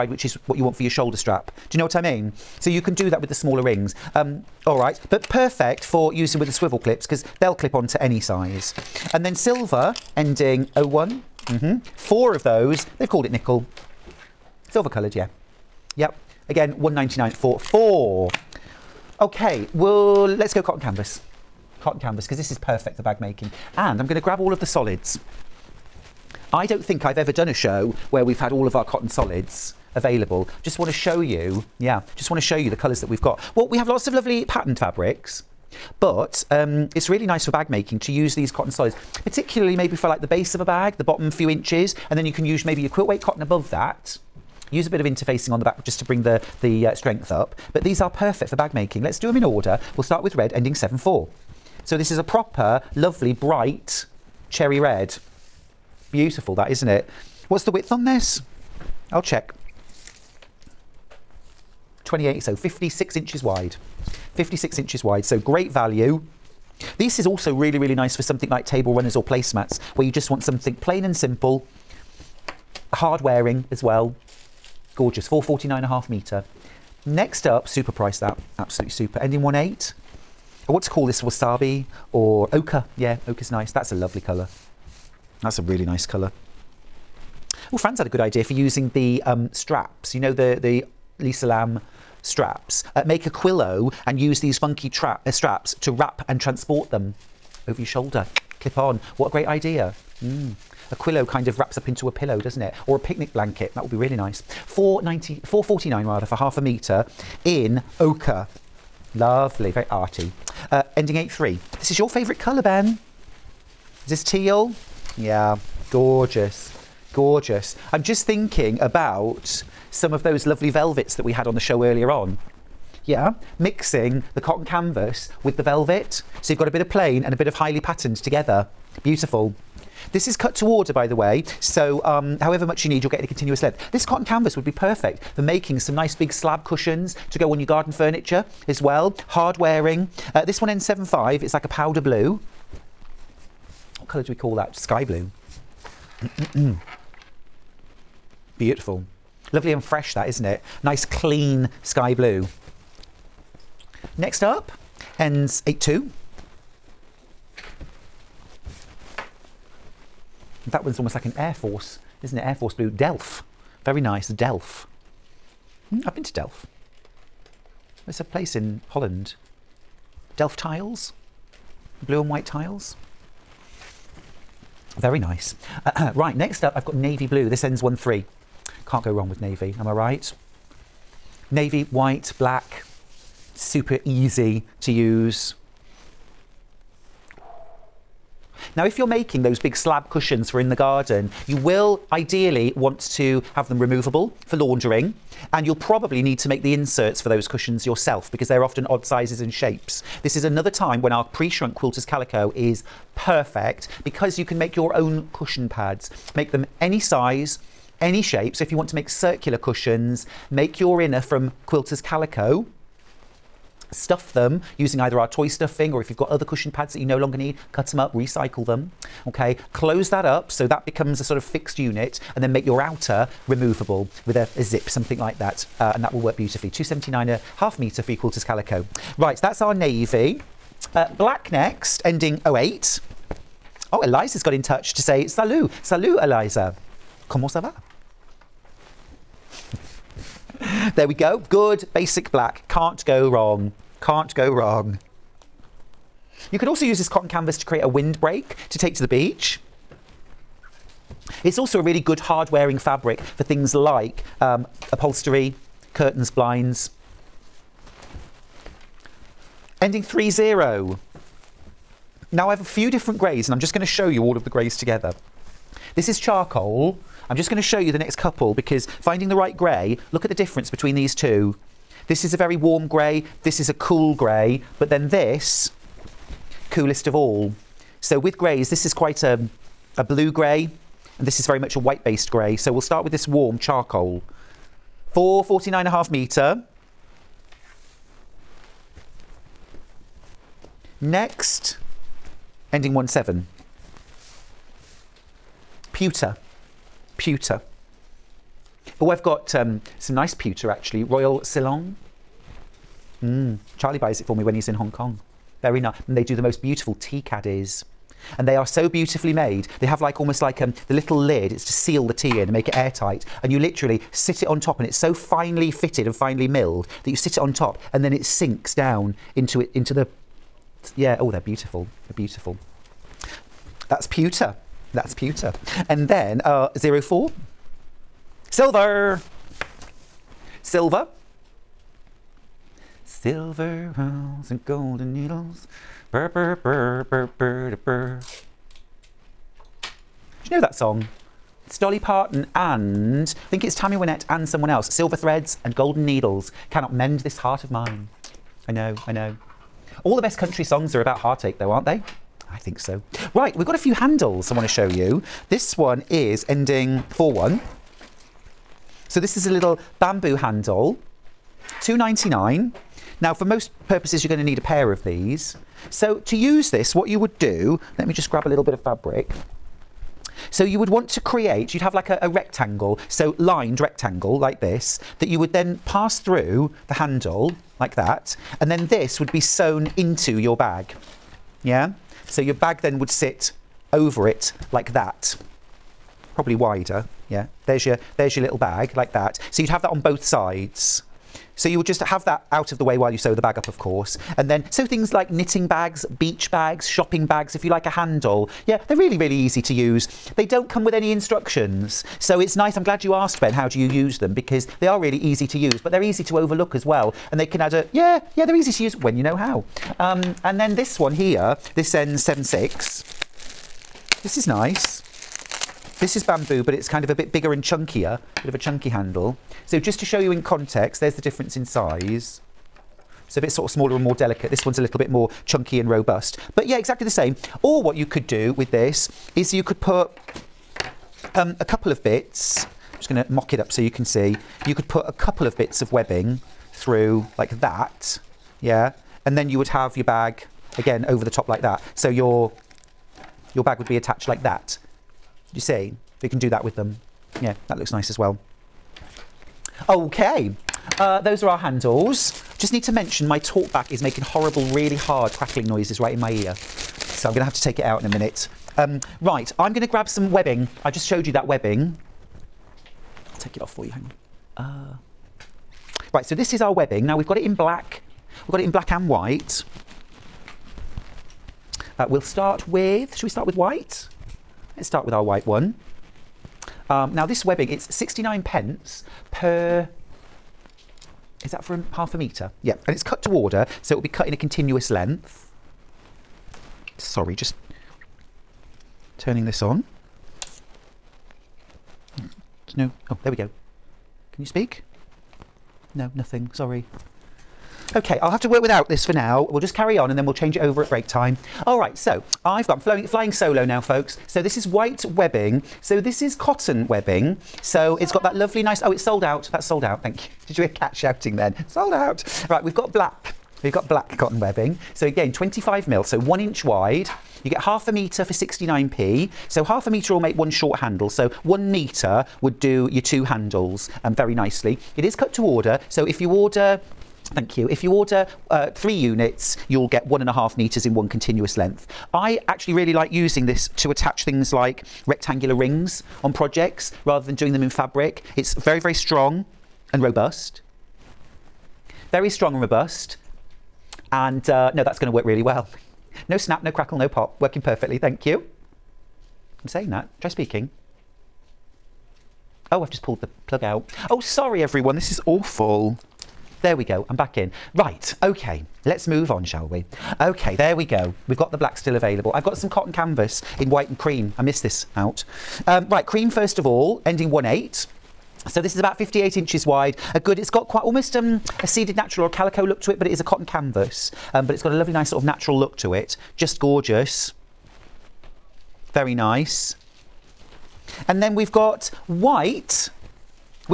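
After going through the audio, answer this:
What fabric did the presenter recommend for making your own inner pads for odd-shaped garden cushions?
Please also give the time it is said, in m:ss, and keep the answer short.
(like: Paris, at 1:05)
pre-shrunk quilters calico, at 3:21.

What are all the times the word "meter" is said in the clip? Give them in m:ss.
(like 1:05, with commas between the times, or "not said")
1:16, 8:50.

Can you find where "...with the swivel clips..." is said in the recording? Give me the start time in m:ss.
0:06.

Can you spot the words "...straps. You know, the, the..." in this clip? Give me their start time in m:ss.
1:29.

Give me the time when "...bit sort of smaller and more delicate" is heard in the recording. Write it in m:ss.
7:03.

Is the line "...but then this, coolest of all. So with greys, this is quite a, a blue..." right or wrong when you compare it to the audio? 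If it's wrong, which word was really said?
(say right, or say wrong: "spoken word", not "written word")
right.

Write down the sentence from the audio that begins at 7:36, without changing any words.
So I'm going to have to take it out in a minute.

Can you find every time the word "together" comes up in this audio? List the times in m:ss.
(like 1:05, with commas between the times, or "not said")
2:08, 4:24.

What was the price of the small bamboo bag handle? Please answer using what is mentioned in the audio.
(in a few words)
2.99.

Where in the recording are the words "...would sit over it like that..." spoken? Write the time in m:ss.
6:22.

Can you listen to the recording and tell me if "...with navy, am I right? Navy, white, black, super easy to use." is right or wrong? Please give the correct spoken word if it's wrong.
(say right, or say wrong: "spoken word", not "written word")
right.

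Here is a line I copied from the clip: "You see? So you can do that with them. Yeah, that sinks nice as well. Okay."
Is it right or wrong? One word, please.
wrong.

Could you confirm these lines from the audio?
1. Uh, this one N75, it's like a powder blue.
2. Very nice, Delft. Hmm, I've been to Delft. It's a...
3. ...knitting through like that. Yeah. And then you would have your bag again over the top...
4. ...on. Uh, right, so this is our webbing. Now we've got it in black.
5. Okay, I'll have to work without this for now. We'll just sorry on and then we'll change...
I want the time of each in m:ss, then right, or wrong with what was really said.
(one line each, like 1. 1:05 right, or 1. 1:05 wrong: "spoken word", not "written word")
1. 2:20 right
2. 2:43 right
3. 7:15 wrong: "webbing", not "knitting"
4. 7:44 right
5. 8:17 wrong: "carry", not "sorry".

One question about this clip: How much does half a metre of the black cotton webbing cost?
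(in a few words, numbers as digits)
69p.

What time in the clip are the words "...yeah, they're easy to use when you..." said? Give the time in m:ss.
6:48.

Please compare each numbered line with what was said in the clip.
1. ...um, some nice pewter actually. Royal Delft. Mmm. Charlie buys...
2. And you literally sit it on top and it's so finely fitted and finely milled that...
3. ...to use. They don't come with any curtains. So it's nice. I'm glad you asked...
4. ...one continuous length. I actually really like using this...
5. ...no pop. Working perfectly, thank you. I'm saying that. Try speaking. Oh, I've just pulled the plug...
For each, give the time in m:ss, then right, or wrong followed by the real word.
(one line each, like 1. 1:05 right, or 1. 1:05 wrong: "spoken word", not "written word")
1. 4:59 wrong: "Selangor", not "Delft"
2. 5:13 right
3. 6:39 wrong: "instructions", not "curtains"
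4. 8:50 right
5. 9:06 right.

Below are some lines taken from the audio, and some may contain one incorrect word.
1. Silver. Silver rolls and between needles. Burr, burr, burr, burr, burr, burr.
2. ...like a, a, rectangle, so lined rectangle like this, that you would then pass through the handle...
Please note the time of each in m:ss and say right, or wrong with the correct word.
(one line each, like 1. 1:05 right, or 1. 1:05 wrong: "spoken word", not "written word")
1. 5:30 wrong: "golden", not "between"
2. 6:11 right.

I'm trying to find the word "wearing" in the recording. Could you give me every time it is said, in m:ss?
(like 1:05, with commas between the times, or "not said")
1:13, 2:19, 4:12.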